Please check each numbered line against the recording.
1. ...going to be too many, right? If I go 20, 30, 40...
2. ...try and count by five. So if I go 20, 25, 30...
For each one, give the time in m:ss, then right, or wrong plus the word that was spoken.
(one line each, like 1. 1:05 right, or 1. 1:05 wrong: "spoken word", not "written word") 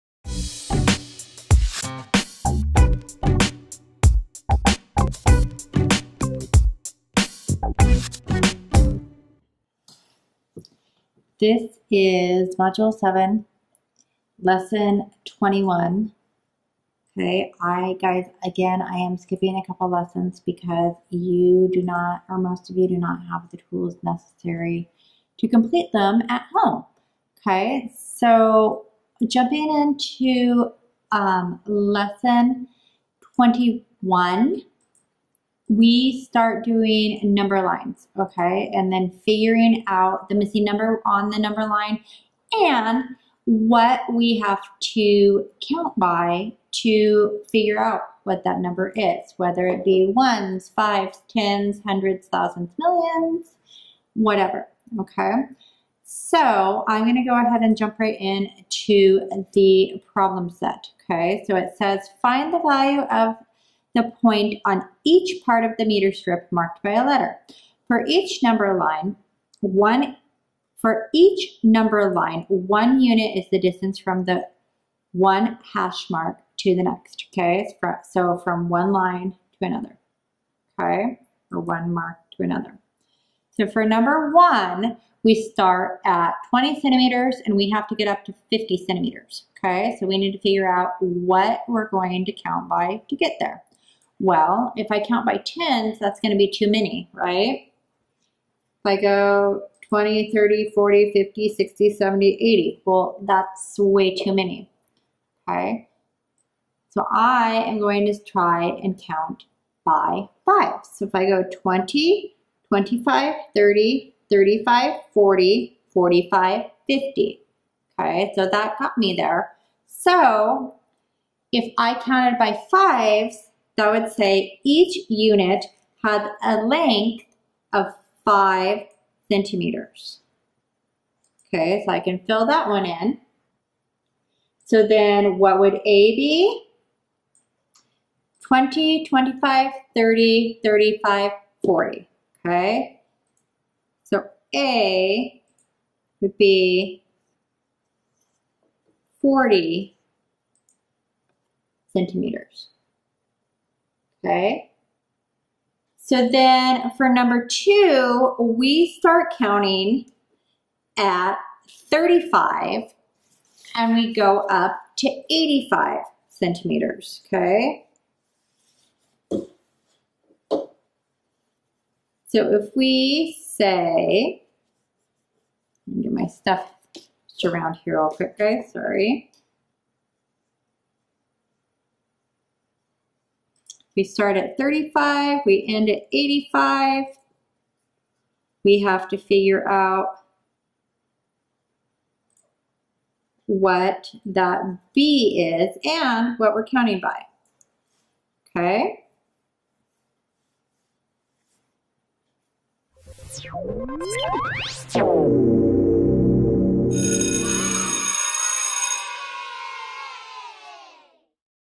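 1. 1:36 right
2. 1:48 right.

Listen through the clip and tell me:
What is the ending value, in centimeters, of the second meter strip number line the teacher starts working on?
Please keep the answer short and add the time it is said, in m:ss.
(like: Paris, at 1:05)
85 centimeters, at 2:45.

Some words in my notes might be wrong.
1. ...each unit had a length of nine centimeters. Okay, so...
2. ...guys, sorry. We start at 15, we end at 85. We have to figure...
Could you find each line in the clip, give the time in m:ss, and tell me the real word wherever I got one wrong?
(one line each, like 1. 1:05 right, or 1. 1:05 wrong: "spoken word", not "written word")
1. 2:04 wrong: "five", not "nine"
2. 2:58 wrong: "35", not "15".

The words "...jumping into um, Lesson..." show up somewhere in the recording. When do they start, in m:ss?
0:29.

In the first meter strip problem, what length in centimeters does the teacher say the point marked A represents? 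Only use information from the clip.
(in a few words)
40 centimeters.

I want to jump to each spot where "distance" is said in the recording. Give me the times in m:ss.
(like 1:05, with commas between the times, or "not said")
1:13.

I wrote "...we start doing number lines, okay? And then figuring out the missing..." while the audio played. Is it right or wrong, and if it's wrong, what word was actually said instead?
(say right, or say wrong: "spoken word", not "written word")
right.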